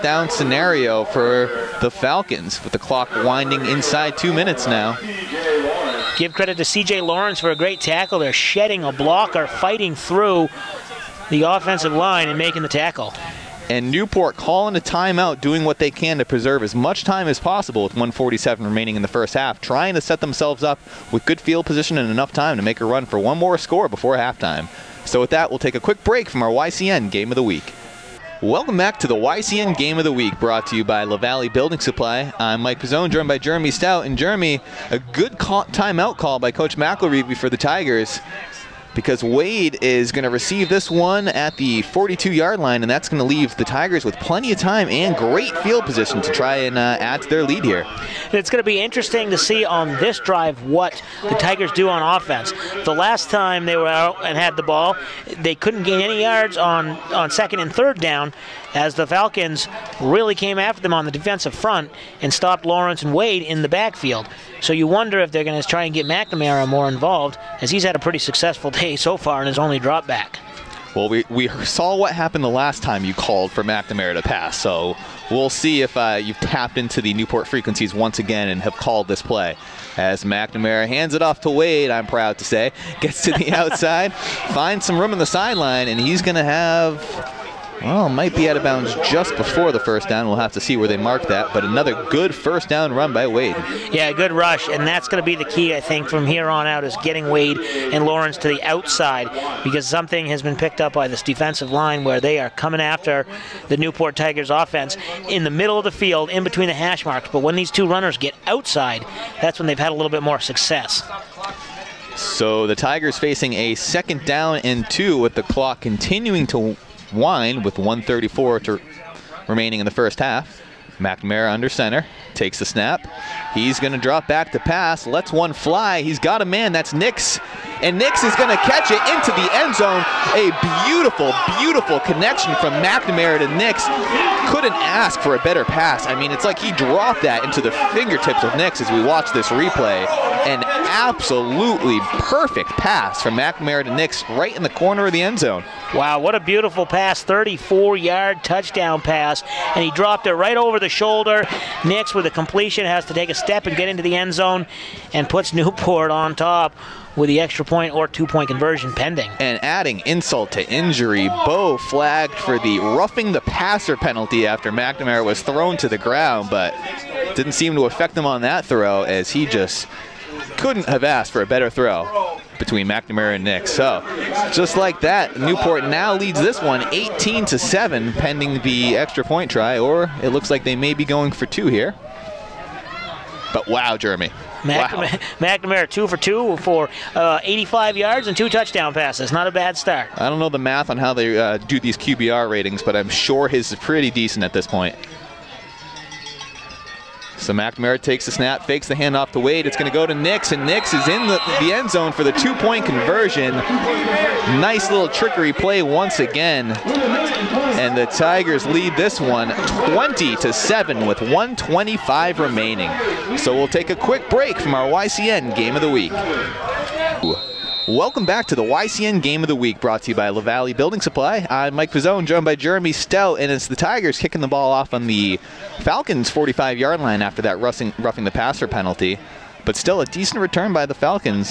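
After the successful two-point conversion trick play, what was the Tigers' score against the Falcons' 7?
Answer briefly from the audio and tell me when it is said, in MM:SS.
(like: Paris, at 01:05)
20, at 03:29.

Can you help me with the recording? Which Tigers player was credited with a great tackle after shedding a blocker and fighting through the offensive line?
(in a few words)
C.J. Lawrence.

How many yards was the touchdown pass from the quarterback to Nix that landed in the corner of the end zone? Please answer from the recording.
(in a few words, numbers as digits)
34.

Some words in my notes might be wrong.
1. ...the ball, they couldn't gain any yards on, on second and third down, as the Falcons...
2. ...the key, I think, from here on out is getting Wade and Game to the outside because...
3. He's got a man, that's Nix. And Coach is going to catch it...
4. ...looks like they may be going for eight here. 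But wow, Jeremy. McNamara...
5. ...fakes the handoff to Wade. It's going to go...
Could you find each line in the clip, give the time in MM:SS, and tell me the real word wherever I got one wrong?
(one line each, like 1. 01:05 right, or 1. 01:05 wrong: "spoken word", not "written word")
1. 00:54 right
2. 01:35 wrong: "Lawrence", not "Game"
3. 02:06 wrong: "Nix", not "Coach"
4. 03:00 wrong: "two", not "eight"
5. 03:18 right.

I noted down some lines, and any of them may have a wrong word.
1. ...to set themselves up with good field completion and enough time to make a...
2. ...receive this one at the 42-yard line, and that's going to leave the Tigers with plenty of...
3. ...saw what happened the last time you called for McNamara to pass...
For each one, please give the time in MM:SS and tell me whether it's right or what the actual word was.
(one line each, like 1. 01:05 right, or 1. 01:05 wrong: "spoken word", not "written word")
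1. 00:19 wrong: "position", not "completion"
2. 00:40 right
3. 01:11 right.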